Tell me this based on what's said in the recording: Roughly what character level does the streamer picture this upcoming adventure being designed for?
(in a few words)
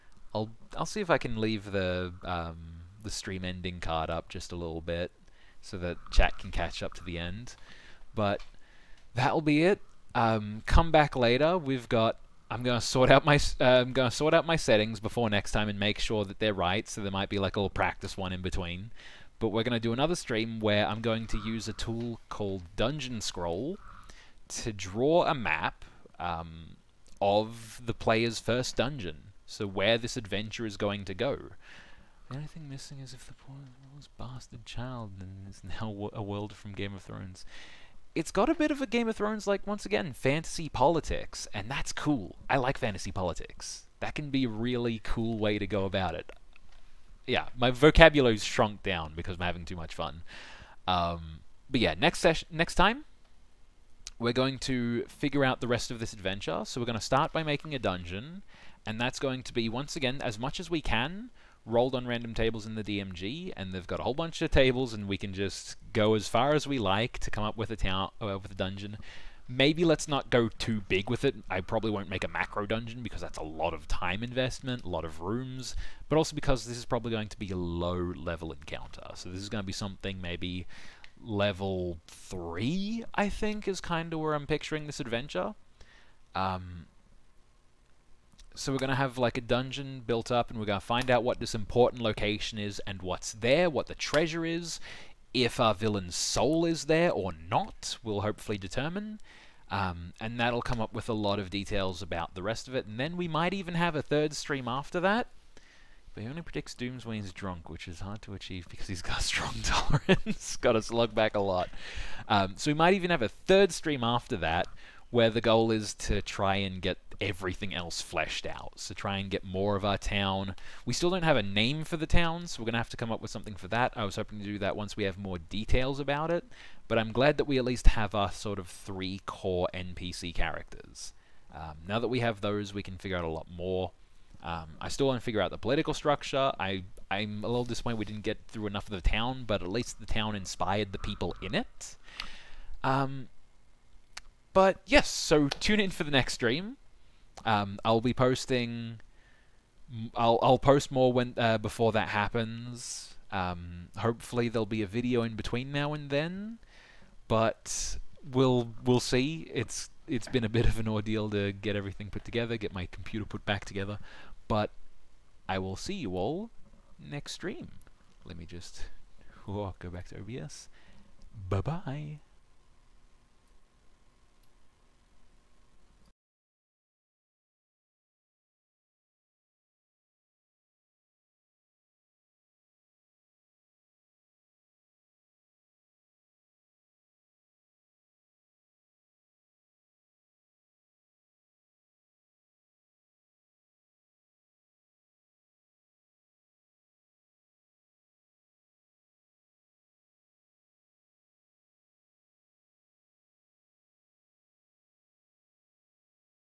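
3.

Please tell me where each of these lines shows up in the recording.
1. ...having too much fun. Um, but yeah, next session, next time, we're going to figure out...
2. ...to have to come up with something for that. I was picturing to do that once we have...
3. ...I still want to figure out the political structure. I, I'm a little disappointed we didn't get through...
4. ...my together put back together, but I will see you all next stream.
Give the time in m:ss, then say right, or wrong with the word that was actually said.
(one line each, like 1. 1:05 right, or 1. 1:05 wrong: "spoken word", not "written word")
1. 0:49 right
2. 2:02 wrong: "hoping", not "picturing"
3. 2:14 right
4. 2:42 wrong: "computer", not "together".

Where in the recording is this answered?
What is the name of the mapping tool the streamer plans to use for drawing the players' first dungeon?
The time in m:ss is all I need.
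0:22.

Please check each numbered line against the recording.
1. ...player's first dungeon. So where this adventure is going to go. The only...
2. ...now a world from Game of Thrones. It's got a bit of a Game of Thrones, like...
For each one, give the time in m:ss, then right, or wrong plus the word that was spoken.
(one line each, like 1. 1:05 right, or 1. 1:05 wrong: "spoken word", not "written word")
1. 0:27 right
2. 0:35 right.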